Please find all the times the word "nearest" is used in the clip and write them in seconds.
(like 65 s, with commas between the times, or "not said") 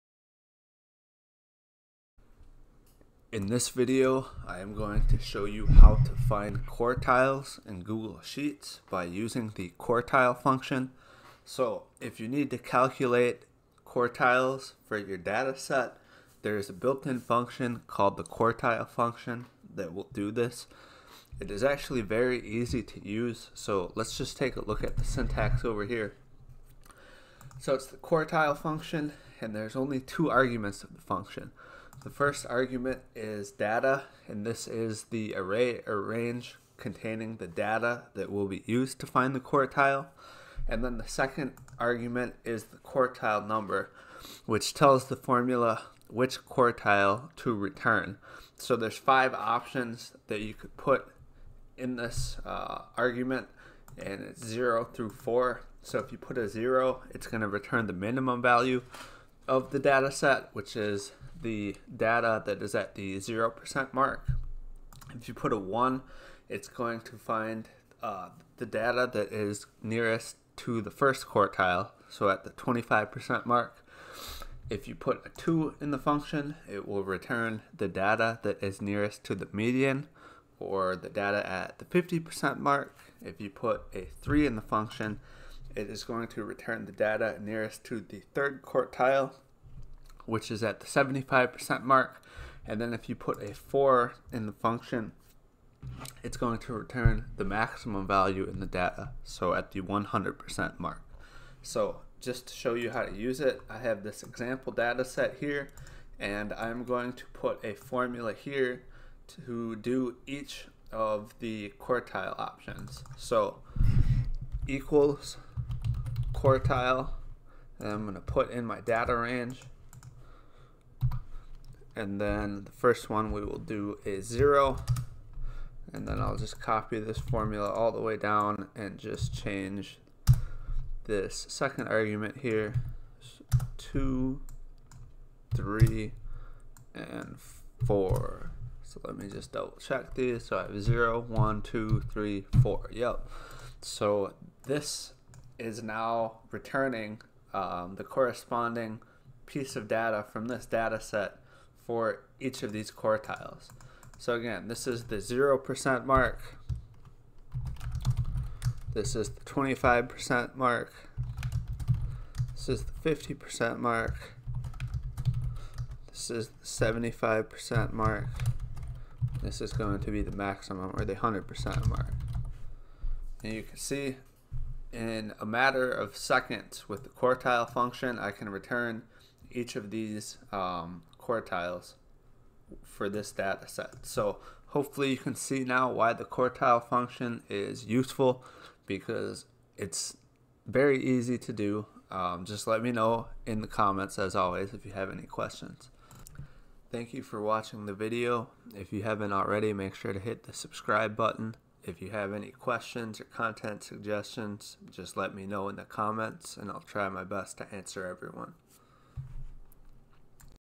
69 s, 78 s, 87 s.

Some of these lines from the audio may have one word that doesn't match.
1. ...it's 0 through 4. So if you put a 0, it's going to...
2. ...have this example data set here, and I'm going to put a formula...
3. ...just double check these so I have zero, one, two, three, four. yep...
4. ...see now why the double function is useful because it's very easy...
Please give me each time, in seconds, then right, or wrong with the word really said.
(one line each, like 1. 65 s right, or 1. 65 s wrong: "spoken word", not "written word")
1. 54 s right
2. 103 s right
3. 139 s right
4. 185 s wrong: "quartile", not "double".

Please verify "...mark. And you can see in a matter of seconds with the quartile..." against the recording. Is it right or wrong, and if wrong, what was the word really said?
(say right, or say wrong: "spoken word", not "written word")
right.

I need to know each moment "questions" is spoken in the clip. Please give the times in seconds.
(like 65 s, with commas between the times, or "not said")
195 s, 202 s.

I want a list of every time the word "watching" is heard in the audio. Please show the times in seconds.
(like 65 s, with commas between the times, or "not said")
197 s.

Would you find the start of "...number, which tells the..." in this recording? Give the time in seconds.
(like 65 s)
43 s.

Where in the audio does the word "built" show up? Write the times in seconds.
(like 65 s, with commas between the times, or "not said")
16 s.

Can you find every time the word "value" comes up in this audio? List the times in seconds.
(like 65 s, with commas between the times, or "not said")
58 s, 98 s.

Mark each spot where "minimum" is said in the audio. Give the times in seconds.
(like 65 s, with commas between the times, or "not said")
57 s.